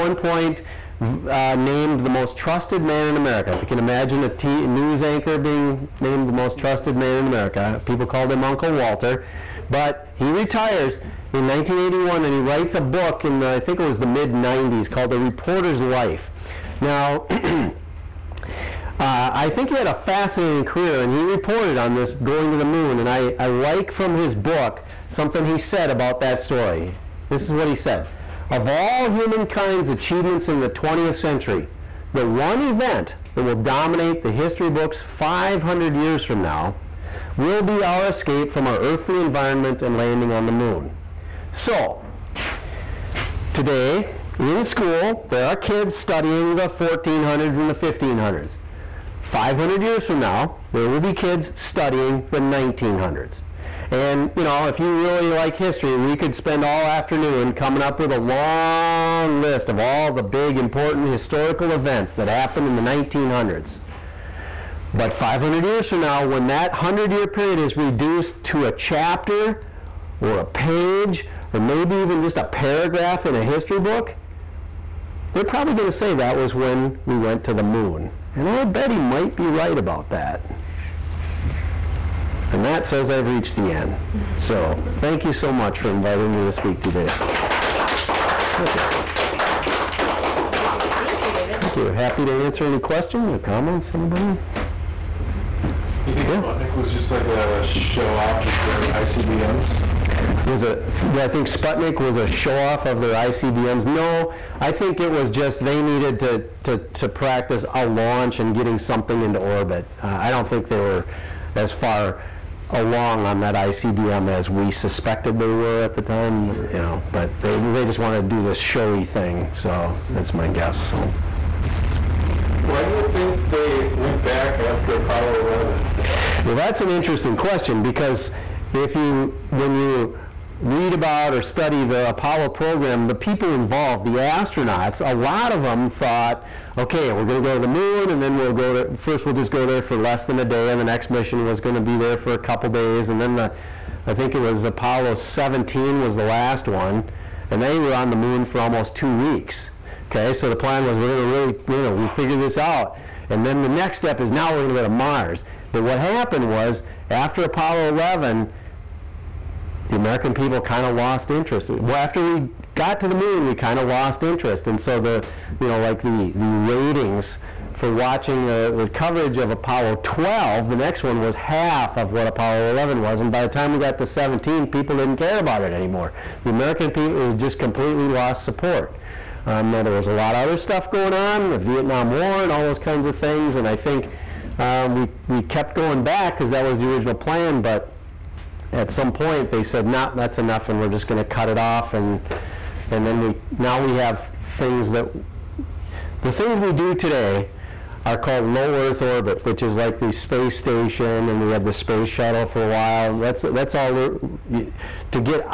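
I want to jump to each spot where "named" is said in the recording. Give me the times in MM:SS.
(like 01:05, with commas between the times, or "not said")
00:01, 00:05.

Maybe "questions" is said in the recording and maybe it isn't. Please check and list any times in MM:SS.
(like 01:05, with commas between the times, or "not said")
01:32, 02:07.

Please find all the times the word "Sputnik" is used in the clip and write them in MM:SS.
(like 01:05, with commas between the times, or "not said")
01:36, 01:41.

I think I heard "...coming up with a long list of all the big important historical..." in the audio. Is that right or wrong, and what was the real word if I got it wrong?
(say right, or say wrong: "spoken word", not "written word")
right.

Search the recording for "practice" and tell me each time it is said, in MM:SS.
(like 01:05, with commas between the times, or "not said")
01:47.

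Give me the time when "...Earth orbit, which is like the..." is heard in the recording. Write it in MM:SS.
03:18.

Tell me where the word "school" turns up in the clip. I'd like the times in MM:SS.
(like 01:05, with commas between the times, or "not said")
00:44.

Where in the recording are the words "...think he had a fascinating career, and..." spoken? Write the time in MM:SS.
00:19.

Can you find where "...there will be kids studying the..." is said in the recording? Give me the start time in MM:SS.
00:50.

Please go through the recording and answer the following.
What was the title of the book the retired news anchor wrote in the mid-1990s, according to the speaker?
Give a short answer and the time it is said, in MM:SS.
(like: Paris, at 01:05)
The Reporter's Life, at 00:15.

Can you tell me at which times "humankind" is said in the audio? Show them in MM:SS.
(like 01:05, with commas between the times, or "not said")
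00:29.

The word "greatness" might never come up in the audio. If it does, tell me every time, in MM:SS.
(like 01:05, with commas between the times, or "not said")
not said.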